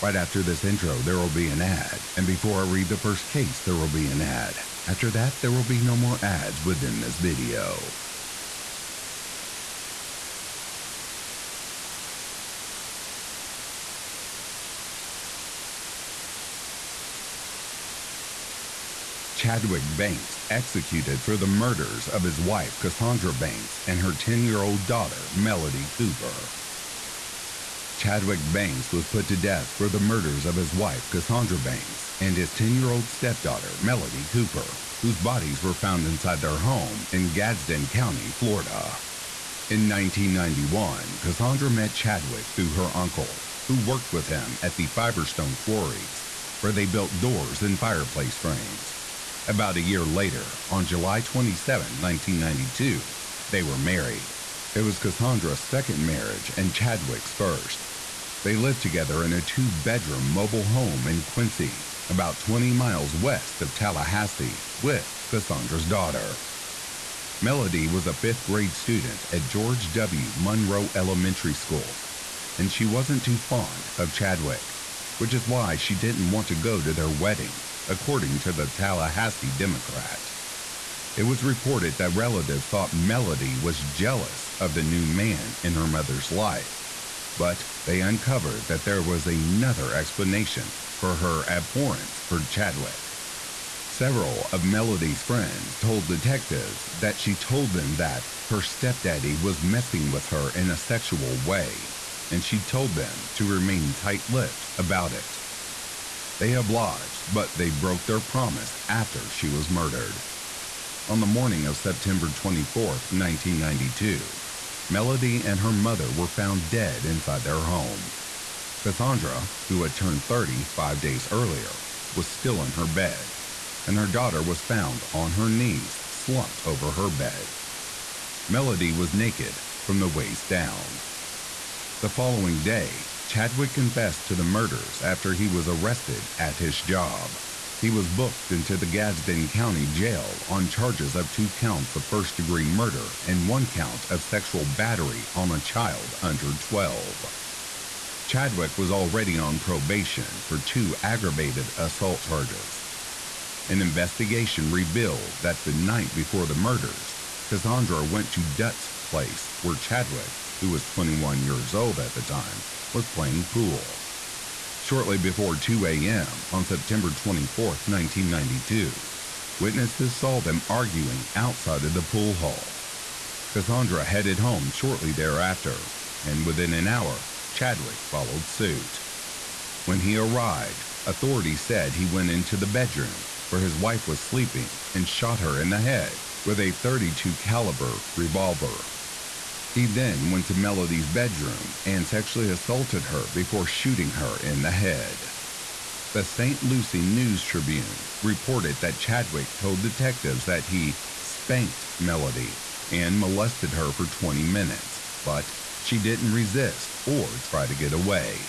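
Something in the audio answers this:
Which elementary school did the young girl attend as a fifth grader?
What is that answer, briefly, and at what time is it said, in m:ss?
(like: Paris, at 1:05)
George W. Munroe Elementary School, at 1:09.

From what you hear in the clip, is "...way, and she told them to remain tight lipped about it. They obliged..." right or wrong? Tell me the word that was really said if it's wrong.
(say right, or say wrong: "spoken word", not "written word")
right.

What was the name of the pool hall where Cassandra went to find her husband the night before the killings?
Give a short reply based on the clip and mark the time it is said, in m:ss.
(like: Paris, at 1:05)
Dutt's place, at 2:38.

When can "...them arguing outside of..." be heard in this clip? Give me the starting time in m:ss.
2:50.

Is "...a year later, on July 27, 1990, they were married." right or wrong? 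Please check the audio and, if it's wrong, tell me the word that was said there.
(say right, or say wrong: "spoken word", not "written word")
wrong: "1992", not "1990".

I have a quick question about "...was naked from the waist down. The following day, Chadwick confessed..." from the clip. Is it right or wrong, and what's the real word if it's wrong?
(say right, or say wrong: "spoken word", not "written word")
right.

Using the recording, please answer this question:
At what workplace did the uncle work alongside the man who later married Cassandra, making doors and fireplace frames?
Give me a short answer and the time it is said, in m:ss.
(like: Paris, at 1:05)
Fiberstone Quarries, at 0:44.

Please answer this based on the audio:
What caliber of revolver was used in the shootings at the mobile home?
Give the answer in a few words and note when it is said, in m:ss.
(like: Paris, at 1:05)
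32 caliber, at 3:06.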